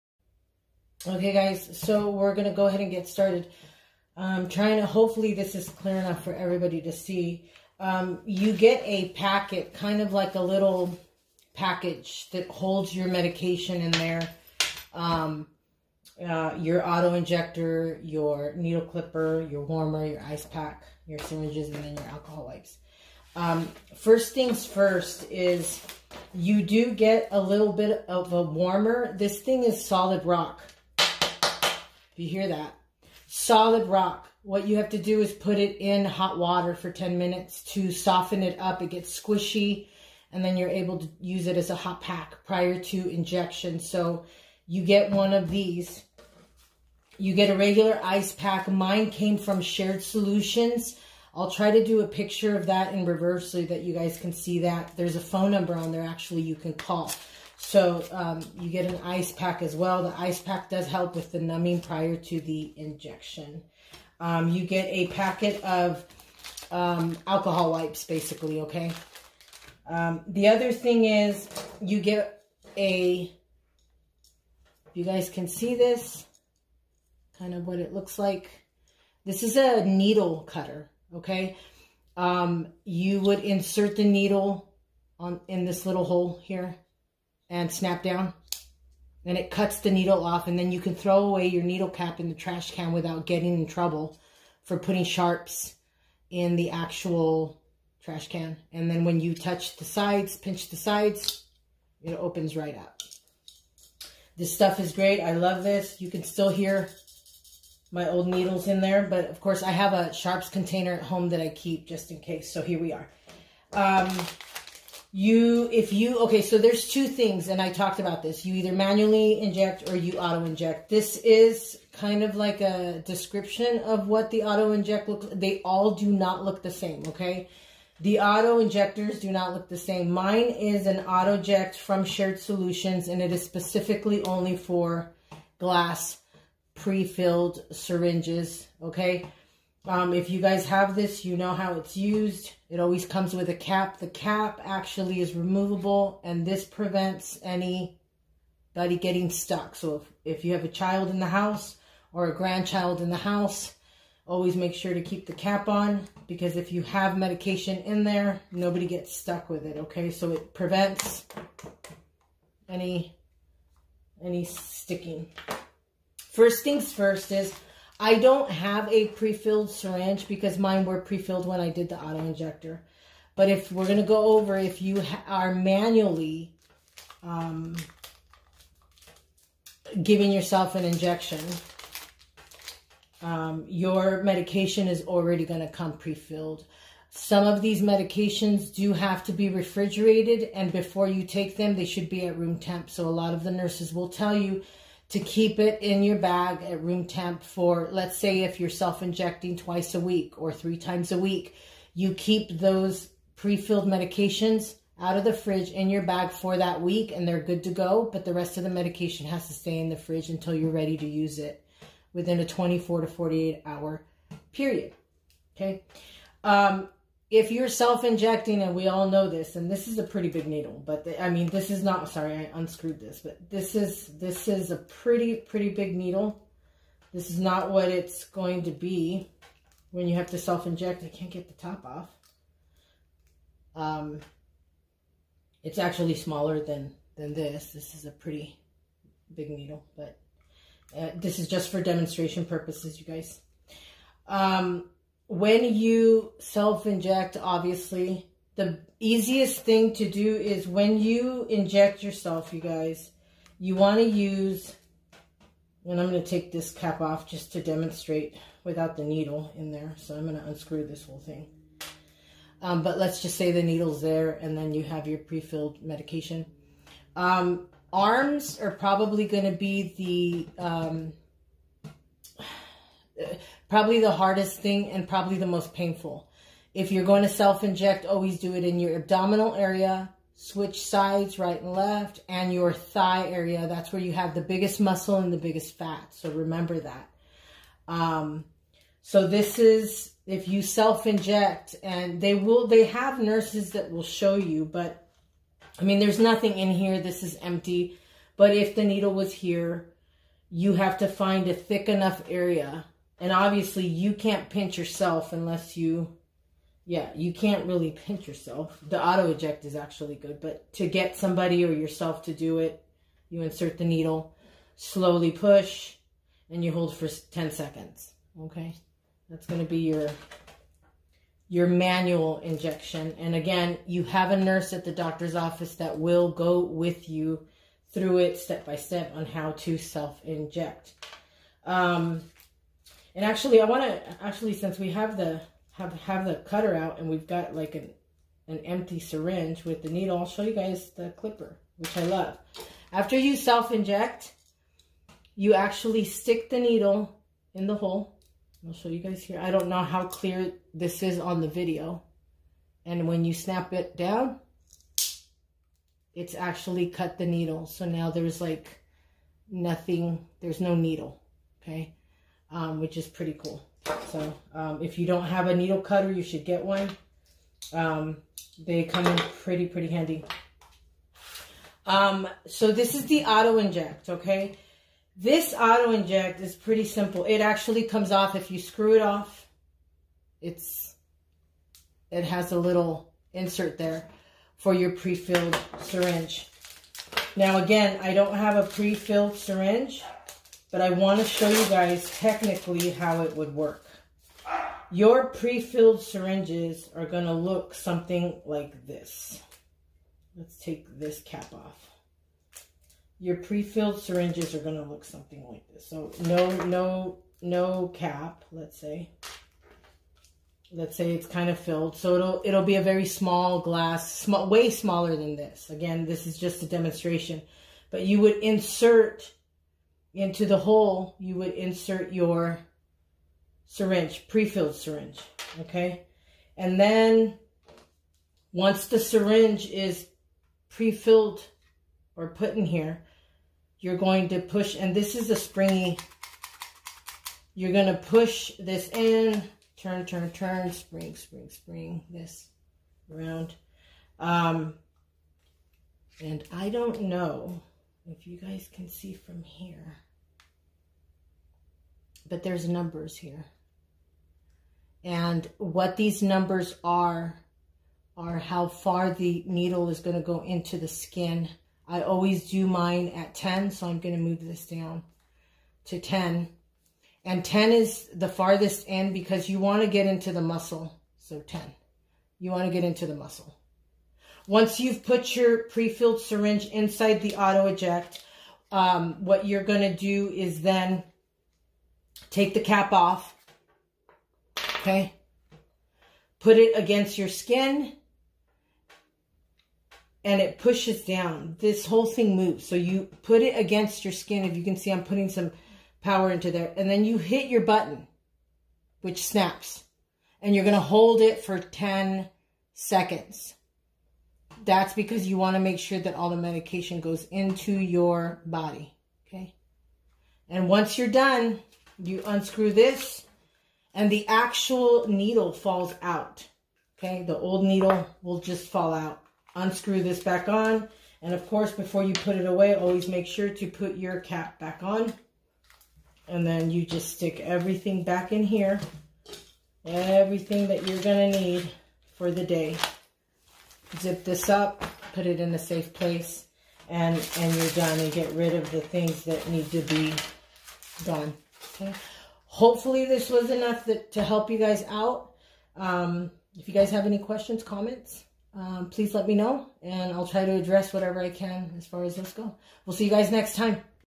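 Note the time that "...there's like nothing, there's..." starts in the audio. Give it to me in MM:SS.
05:58.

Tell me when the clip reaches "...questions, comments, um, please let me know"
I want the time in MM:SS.
09:07.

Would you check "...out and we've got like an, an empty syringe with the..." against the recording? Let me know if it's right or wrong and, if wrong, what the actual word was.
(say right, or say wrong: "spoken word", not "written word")
right.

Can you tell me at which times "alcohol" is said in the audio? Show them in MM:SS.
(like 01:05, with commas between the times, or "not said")
00:22, 01:07.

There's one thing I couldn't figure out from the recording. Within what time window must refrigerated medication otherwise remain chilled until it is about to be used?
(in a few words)
24 to 48 hours.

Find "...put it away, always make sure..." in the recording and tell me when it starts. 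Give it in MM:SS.
08:42.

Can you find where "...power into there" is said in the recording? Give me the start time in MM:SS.
08:16.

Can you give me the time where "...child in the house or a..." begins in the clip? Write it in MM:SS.
02:30.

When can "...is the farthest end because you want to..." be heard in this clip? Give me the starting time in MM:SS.
07:47.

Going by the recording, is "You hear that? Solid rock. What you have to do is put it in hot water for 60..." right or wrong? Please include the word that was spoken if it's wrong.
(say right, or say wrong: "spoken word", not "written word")
wrong: "10", not "60".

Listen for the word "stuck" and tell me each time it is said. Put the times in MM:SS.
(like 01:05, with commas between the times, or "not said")
02:29, 02:39.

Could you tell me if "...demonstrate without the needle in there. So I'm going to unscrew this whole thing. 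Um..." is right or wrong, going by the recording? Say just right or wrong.
right.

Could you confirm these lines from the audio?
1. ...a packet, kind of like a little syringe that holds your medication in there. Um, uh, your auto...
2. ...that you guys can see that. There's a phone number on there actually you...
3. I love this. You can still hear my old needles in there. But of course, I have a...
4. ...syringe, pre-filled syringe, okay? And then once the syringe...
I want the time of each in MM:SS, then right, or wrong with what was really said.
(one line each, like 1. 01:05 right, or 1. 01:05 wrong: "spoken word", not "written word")
1. 00:08 wrong: "package", not "syringe"
2. 00:53 right
3. 01:45 right
4. 07:03 right.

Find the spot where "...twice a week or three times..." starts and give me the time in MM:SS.
03:19.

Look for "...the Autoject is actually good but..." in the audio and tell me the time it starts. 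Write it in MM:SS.
05:08.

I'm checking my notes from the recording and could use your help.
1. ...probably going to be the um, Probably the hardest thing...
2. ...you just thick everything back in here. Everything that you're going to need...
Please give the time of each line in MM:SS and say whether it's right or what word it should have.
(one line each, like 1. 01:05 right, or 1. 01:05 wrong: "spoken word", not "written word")
1. 04:28 right
2. 08:46 wrong: "stick", not "thick".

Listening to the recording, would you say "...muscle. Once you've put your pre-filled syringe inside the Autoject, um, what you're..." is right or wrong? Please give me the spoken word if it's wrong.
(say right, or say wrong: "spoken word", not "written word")
right.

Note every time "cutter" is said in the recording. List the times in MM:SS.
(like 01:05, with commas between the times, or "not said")
01:20, 05:36, 06:05.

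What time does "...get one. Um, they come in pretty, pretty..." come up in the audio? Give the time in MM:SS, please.
06:06.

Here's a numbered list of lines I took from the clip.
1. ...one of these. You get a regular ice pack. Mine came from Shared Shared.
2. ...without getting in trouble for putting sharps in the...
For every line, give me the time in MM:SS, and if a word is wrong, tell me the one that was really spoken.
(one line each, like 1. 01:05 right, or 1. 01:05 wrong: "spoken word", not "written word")
1. 00:45 wrong: "Solutions", not "Shared"
2. 01:32 right.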